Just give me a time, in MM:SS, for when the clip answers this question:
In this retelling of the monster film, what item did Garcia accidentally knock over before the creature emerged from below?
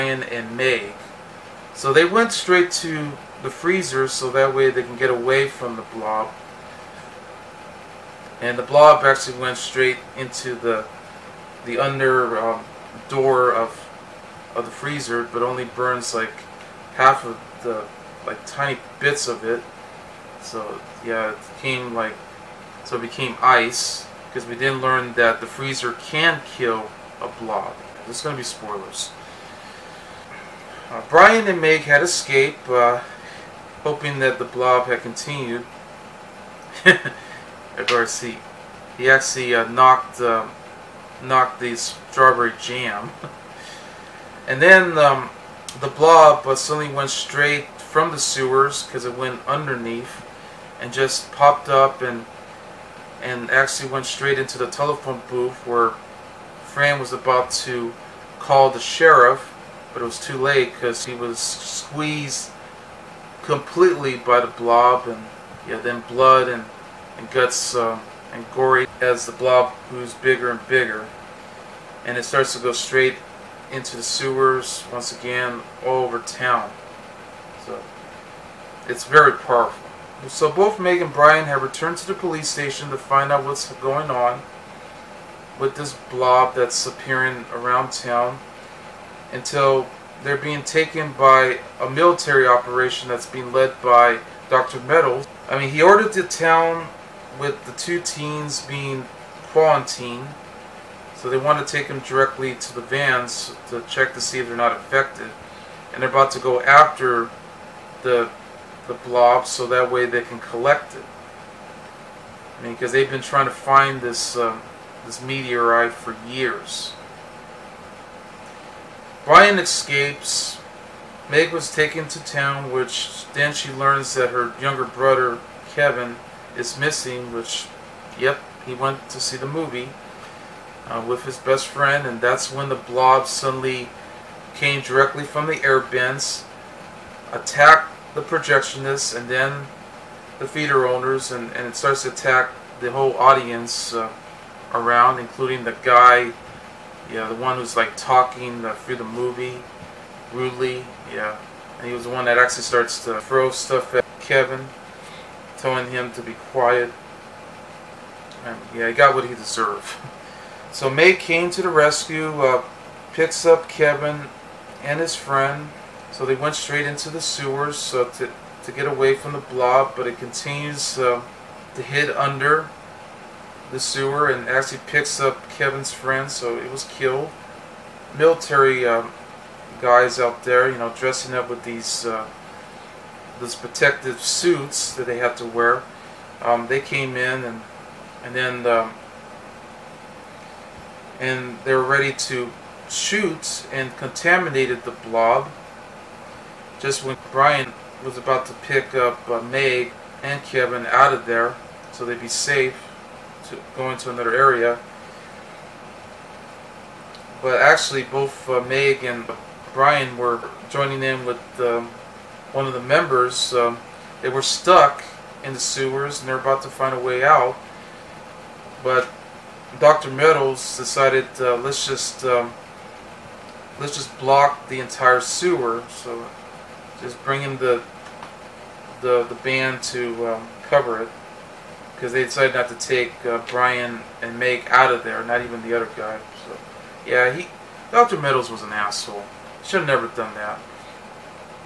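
00:41.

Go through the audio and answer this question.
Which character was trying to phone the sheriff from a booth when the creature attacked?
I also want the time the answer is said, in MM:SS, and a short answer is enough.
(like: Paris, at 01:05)
Fran, at 00:56.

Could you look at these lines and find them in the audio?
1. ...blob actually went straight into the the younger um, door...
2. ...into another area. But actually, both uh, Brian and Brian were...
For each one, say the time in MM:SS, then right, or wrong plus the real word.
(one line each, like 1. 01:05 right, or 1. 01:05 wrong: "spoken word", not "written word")
1. 00:08 wrong: "under", not "younger"
2. 03:23 wrong: "Meg", not "Brian".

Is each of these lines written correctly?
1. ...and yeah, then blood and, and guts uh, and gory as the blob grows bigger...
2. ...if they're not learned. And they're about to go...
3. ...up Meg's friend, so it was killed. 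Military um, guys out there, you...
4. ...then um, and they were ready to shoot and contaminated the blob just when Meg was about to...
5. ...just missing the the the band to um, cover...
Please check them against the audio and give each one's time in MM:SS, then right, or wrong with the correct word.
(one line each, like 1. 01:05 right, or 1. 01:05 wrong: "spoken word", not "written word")
1. 01:05 right
2. 01:44 wrong: "affected", not "learned"
3. 02:55 wrong: "Kevin", not "Meg"
4. 03:08 wrong: "Brian", not "Meg"
5. 03:47 wrong: "bringing", not "missing".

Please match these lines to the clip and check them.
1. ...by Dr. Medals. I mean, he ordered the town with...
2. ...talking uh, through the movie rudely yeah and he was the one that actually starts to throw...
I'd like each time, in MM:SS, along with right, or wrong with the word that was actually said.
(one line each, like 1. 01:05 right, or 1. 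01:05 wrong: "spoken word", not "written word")
1. 01:33 right
2. 02:27 right.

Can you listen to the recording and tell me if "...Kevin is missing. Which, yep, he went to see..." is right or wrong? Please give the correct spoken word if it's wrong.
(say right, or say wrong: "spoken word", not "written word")
right.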